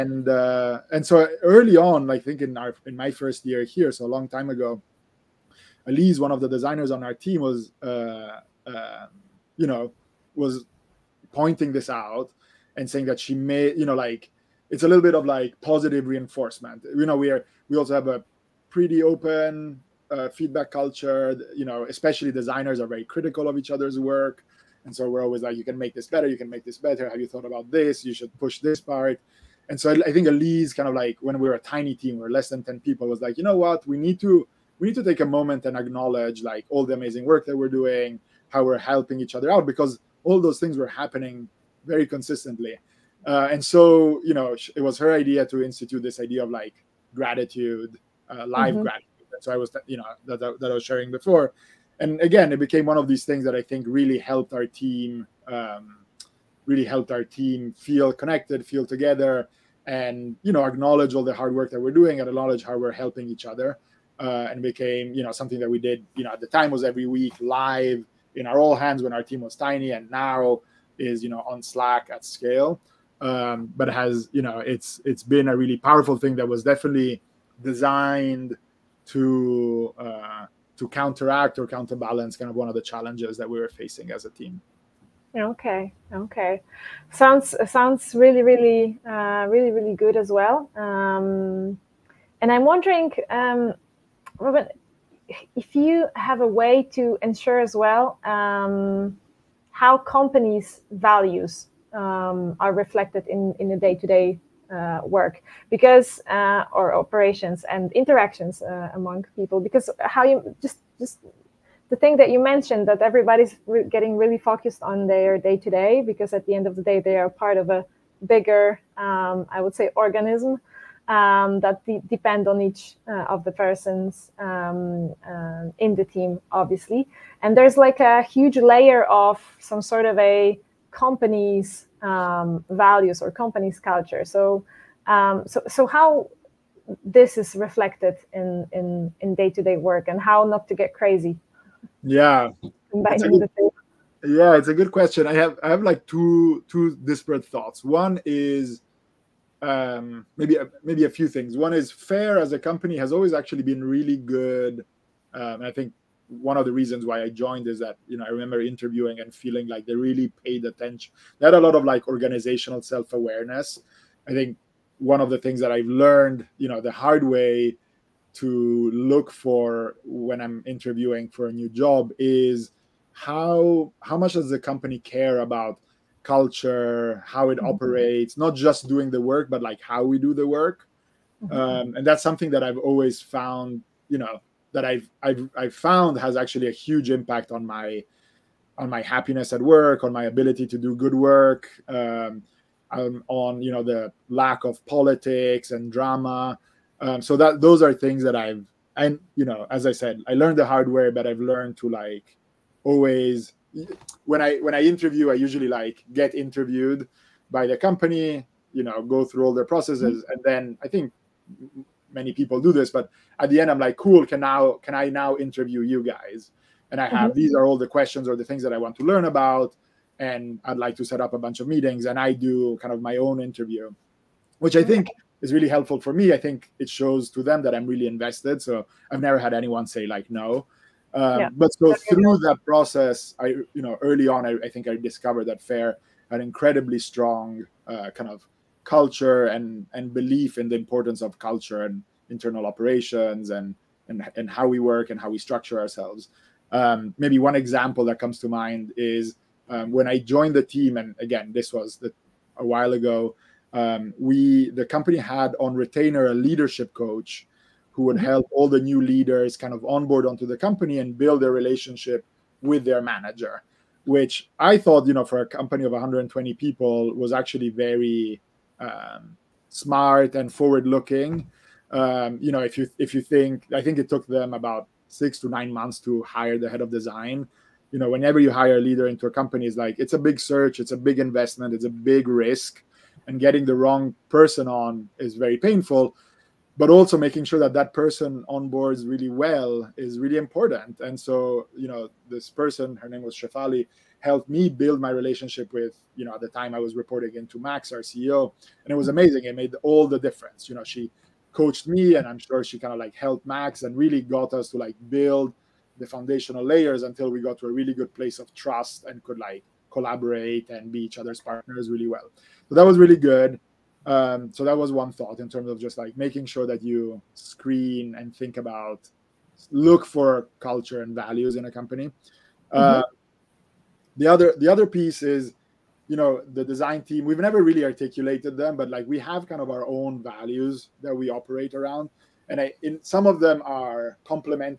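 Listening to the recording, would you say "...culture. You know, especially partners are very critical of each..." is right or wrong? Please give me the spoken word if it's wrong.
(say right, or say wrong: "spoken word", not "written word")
wrong: "designers", not "partners".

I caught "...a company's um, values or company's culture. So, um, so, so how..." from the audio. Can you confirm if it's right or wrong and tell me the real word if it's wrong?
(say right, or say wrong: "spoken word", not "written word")
right.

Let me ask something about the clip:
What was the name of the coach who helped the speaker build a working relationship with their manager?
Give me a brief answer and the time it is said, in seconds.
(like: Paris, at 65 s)
Shefali, at 293 s.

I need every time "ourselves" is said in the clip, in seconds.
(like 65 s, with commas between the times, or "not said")
245 s.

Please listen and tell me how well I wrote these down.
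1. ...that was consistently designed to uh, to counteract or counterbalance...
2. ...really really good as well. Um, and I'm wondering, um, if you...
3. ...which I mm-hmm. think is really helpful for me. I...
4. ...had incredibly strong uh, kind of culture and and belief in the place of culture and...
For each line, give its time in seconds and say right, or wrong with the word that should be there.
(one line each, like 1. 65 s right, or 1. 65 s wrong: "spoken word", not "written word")
1. 76 s wrong: "definitely", not "consistently"
2. 89 s right
3. 224 s right
4. 236 s wrong: "importance", not "place".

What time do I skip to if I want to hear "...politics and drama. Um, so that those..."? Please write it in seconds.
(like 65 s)
194 s.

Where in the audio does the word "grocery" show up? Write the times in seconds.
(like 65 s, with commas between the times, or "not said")
not said.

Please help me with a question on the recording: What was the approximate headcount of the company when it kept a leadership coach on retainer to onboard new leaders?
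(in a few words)
120.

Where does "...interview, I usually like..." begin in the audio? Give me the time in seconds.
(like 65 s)
204 s.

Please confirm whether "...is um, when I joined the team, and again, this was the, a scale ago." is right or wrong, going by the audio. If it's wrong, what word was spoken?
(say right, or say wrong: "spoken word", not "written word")
wrong: "while", not "scale".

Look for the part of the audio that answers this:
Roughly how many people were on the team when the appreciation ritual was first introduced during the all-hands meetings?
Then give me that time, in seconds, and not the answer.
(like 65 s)
32 s.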